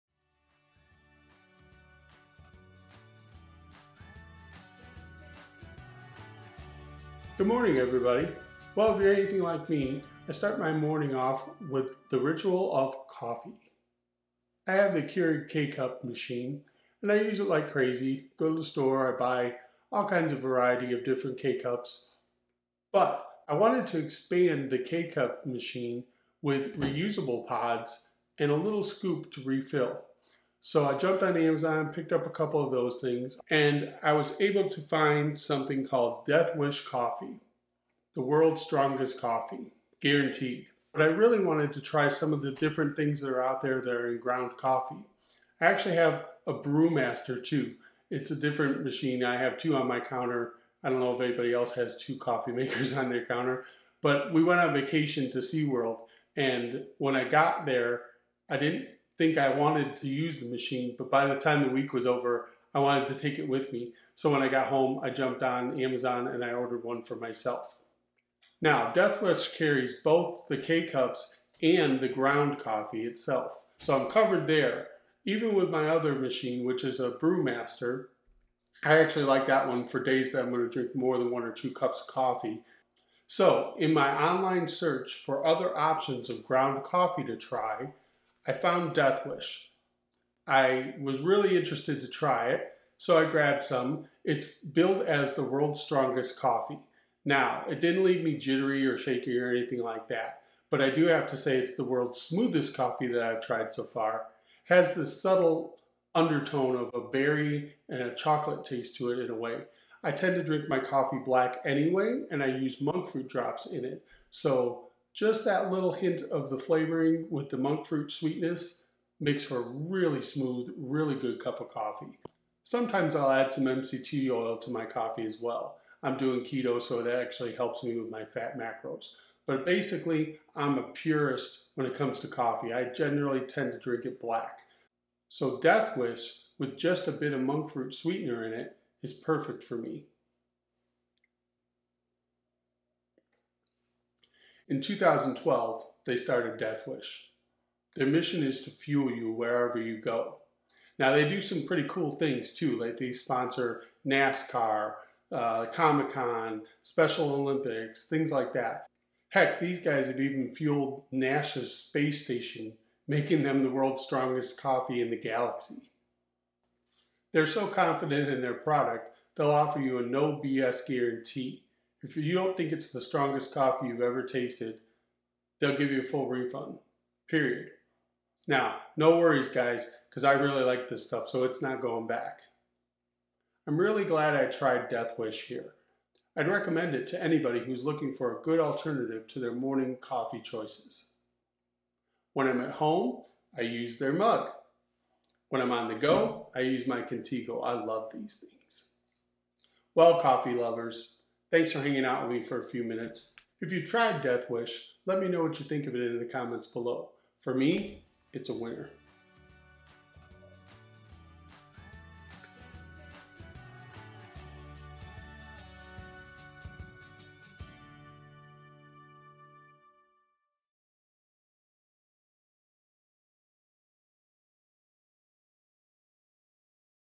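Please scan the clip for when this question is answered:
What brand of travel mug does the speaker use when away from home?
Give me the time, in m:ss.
3:17.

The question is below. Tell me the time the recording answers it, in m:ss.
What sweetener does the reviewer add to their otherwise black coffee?
1:52.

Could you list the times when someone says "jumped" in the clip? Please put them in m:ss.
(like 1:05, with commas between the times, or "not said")
0:30, 1:05.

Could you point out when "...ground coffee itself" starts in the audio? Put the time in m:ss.
1:12.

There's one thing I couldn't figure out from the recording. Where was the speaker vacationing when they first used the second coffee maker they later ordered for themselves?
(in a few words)
SeaWorld.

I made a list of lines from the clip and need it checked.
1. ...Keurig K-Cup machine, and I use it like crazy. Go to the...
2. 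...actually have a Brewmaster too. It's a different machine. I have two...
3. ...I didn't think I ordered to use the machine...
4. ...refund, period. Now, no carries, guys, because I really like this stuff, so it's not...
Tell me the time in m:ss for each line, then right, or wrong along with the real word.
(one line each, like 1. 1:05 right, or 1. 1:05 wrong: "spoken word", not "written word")
1. 0:15 right
2. 0:45 right
3. 0:58 wrong: "wanted", not "ordered"
4. 2:56 wrong: "worries", not "carries".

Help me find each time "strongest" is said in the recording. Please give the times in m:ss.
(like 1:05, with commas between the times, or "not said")
0:38, 1:35, 2:44, 2:53.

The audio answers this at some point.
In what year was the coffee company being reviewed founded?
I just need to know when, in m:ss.
2:24.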